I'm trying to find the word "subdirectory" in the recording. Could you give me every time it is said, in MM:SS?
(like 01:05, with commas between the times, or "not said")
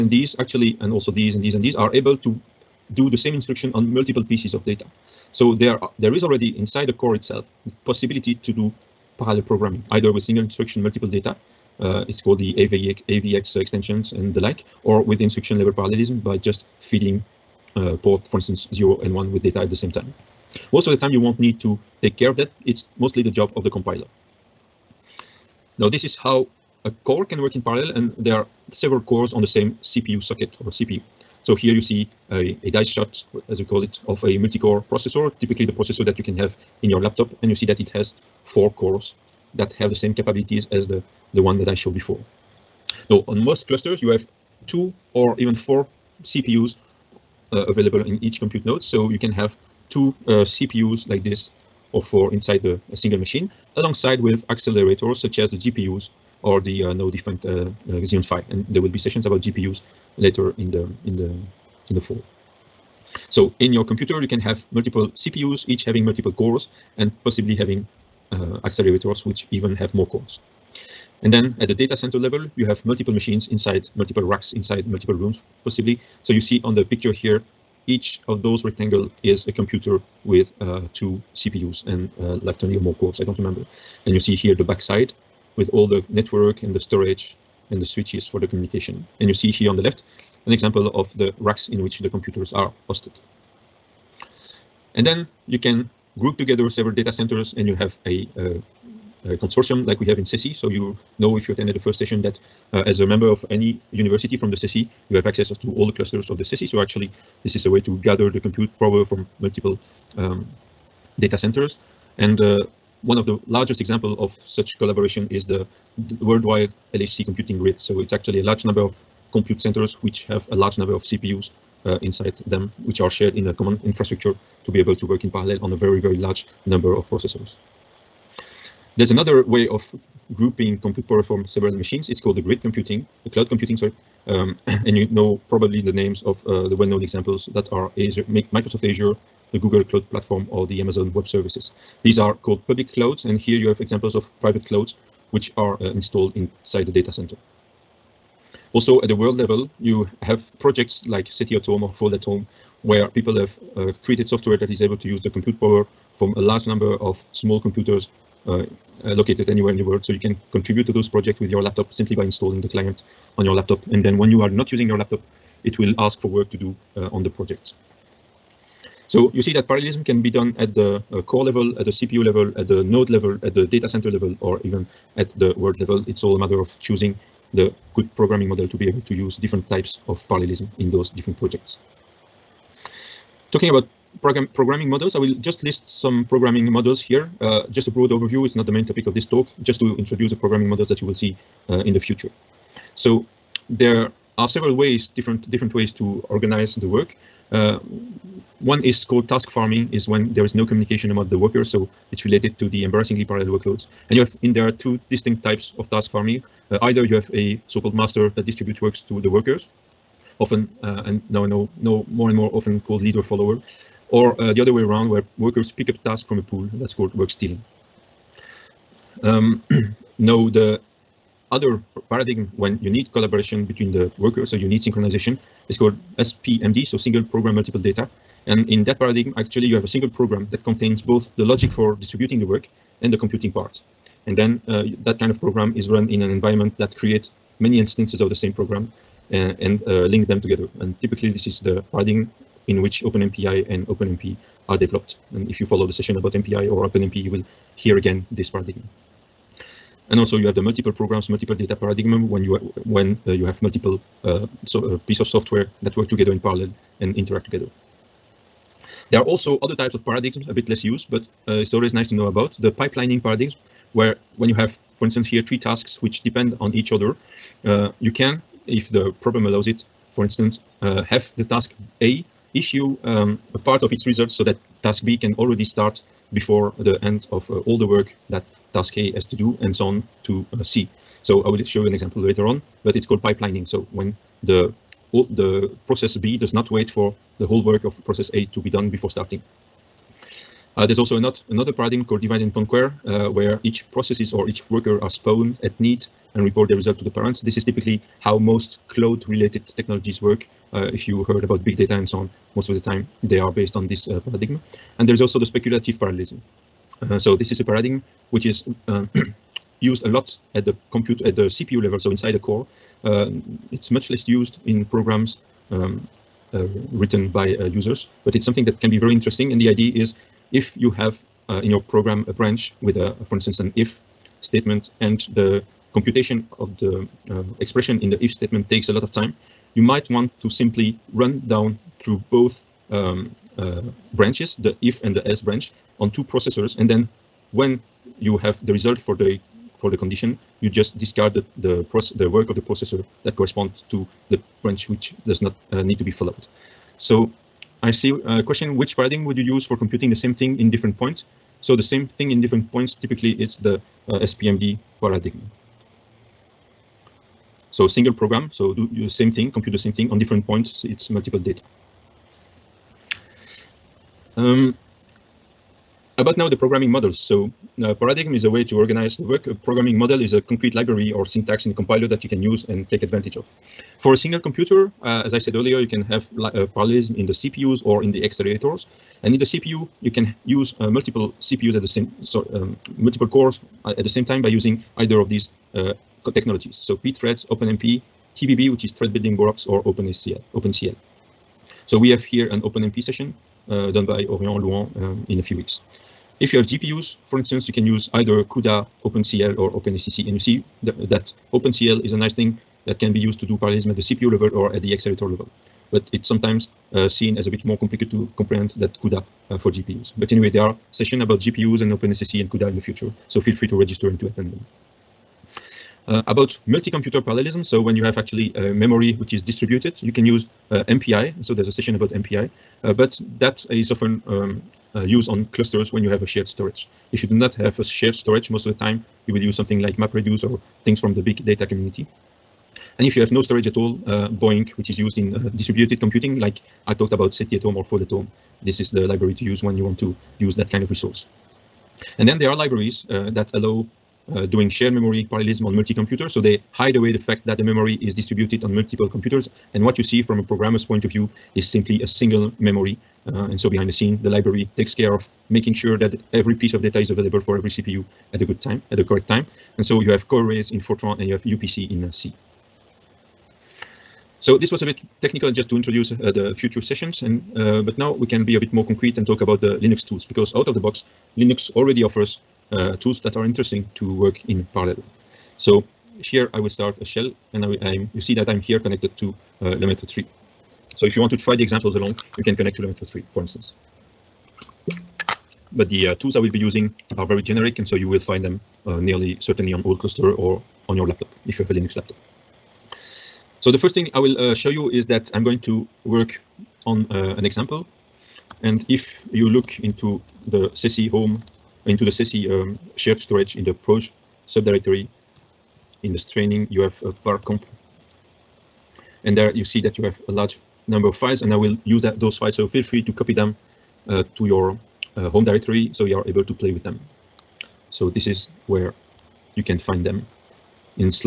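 08:24.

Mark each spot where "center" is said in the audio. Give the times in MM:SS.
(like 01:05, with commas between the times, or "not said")
01:11, 01:37, 01:51, 01:59, 02:27, 02:53.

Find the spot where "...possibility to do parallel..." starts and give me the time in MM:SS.
00:07.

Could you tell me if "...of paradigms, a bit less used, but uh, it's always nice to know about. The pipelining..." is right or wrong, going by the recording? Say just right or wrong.
right.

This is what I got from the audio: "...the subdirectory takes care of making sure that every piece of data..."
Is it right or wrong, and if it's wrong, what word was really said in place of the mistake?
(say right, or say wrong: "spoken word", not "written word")
wrong: "library", not "subdirectory".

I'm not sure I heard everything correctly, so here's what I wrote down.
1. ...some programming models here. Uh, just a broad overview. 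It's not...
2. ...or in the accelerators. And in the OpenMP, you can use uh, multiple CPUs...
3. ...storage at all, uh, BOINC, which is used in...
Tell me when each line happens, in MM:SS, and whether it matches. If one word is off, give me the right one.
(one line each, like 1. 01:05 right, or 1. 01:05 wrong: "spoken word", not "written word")
1. 03:05 right
2. 06:17 wrong: "CPU", not "OpenMP"
3. 07:13 right.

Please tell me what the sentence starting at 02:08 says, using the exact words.
There's another way of grouping compute power from several machines.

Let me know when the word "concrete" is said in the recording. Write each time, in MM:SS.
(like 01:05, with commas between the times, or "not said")
06:10, 07:48.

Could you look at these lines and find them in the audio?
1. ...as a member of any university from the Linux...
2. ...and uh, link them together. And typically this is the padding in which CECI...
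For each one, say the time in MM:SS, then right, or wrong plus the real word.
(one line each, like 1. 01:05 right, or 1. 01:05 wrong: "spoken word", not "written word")
1. 01:42 wrong: "CECI", not "Linux"
2. 03:59 wrong: "OpenMPI", not "CECI".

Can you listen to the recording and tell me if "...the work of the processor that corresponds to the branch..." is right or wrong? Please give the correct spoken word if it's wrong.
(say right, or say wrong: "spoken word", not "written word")
right.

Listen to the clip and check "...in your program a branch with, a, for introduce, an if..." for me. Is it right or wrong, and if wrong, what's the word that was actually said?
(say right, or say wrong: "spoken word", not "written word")
wrong: "instance", not "introduce".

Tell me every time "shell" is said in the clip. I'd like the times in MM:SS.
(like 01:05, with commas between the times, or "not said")
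07:57.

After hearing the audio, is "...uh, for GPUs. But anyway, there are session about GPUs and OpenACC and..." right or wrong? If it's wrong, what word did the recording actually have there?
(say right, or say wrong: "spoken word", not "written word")
right.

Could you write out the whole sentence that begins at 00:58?
And there will be sessions about GPUs later in the in the in the fall.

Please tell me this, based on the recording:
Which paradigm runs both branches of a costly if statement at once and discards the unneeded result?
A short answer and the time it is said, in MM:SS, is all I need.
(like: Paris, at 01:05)
Speculative parallelism, at 05:05.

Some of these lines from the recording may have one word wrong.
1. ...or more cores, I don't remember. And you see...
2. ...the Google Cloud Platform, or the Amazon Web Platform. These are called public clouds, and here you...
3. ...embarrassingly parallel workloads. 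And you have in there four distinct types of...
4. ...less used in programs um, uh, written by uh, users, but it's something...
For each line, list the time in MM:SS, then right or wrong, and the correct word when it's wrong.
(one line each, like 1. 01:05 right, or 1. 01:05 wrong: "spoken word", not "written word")
1. 01:22 right
2. 02:19 wrong: "Services", not "Platform"
3. 03:22 wrong: "two", not "four"
4. 05:14 right.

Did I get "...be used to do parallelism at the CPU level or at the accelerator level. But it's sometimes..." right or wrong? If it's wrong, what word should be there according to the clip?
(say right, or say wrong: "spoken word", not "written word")
right.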